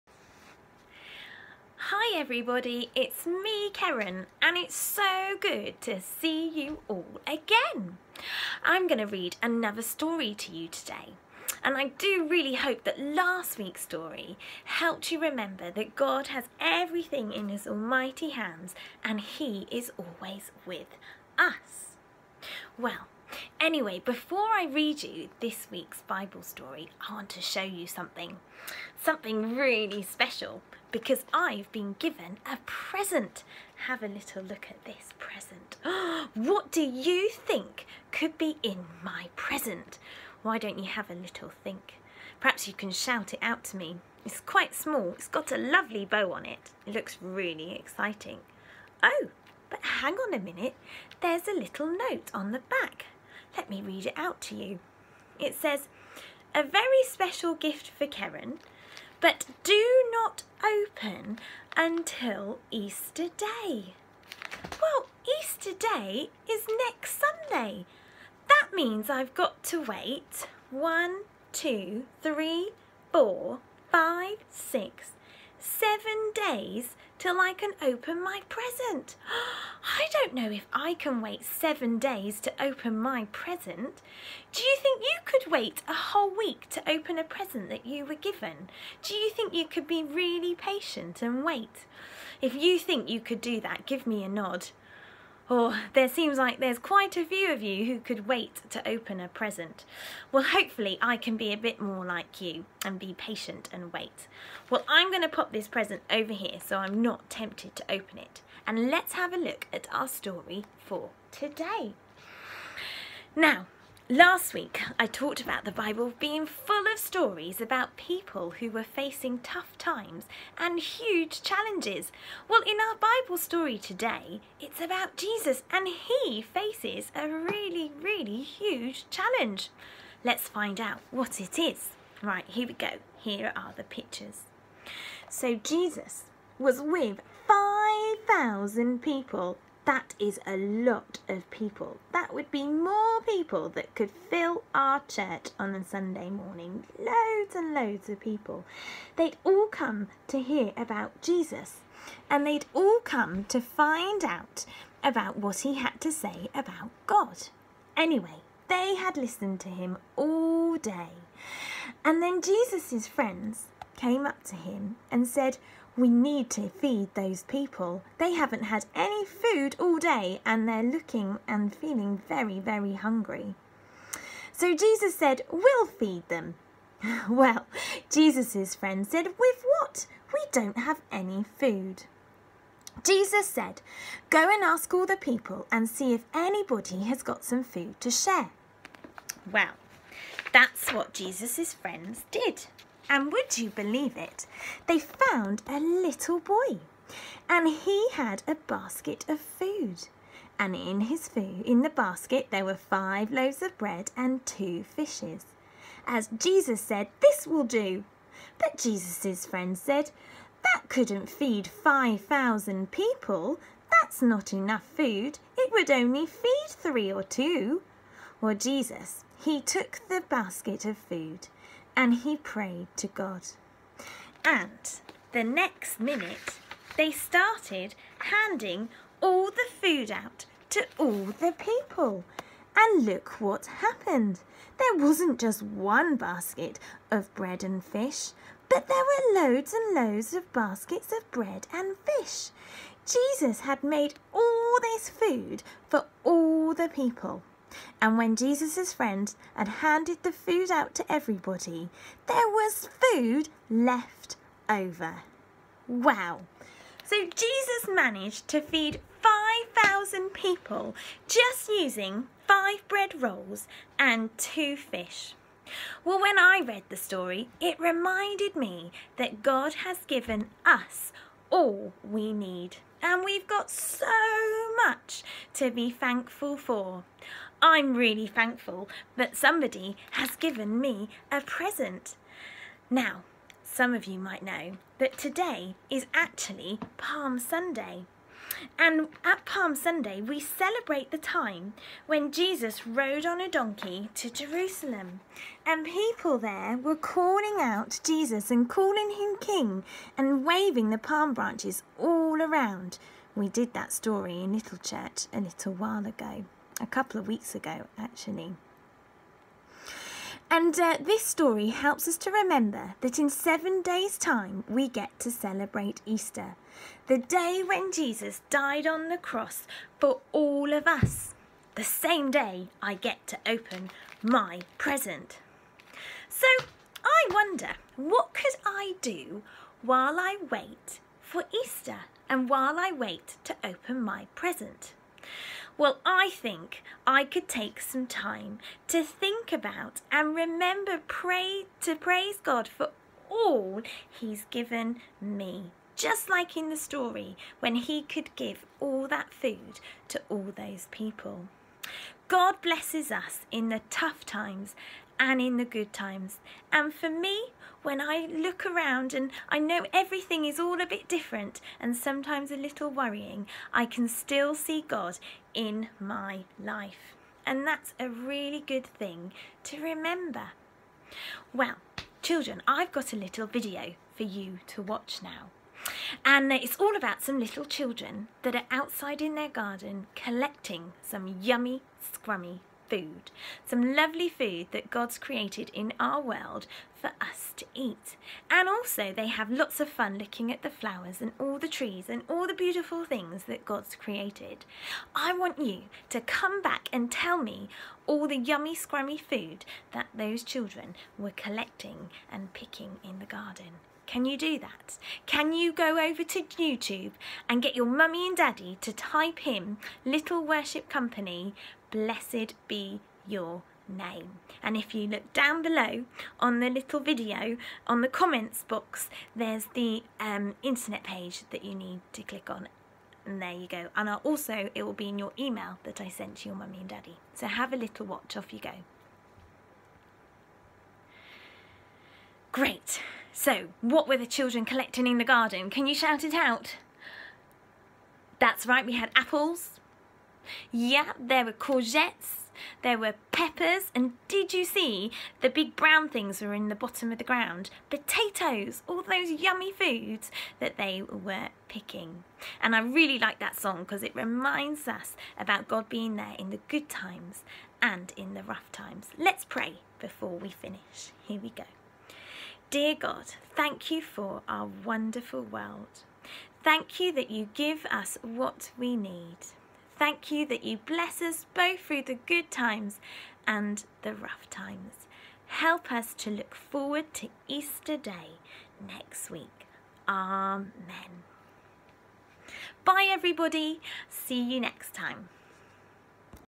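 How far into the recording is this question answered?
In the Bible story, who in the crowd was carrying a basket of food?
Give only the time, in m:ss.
3:15.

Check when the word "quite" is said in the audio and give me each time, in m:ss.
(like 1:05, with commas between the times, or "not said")
0:44, 1:36.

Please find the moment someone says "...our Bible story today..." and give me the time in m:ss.
2:02.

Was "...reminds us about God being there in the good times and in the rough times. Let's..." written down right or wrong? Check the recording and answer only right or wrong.
right.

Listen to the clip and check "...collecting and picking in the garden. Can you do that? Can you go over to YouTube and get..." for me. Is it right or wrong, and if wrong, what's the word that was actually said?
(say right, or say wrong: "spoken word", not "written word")
right.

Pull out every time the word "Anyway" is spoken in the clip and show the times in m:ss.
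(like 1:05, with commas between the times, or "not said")
0:23, 2:37.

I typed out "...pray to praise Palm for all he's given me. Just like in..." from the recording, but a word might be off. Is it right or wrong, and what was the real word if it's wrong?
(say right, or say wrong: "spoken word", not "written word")
wrong: "God", not "Palm".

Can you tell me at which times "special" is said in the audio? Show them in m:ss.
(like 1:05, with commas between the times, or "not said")
0:30, 0:57.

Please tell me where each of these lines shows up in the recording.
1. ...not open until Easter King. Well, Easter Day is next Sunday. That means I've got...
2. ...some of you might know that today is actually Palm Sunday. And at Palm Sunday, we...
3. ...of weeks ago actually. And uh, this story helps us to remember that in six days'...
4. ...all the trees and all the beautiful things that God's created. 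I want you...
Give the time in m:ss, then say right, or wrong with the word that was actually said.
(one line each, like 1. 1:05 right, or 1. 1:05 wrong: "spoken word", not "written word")
1. 1:00 wrong: "Day", not "King"
2. 4:43 right
3. 5:07 wrong: "seven", not "six"
4. 6:31 right.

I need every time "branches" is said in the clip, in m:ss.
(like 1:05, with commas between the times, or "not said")
5:01.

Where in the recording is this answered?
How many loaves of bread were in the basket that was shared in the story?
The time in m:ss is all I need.
3:22.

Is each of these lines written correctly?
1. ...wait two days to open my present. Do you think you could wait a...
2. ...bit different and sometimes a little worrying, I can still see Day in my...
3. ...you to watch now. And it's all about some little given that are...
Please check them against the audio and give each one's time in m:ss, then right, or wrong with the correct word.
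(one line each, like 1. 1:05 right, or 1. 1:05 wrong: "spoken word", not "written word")
1. 1:21 wrong: "seven", not "two"
2. 6:00 wrong: "God", not "Day"
3. 6:14 wrong: "children", not "given".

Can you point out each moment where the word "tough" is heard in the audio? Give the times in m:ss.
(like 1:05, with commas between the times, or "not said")
1:59, 5:53.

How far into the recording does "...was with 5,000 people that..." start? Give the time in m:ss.
2:16.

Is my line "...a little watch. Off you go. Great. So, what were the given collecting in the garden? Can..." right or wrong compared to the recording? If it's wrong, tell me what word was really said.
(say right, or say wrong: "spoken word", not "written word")
wrong: "children", not "given".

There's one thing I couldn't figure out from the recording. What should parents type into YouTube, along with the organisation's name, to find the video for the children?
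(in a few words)
blessed be your name.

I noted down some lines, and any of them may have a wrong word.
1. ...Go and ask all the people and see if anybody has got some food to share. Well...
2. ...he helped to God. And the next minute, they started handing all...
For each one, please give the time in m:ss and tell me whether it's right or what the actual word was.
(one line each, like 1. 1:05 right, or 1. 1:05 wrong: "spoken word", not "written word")
1. 3:04 right
2. 3:42 wrong: "prayed", not "helped".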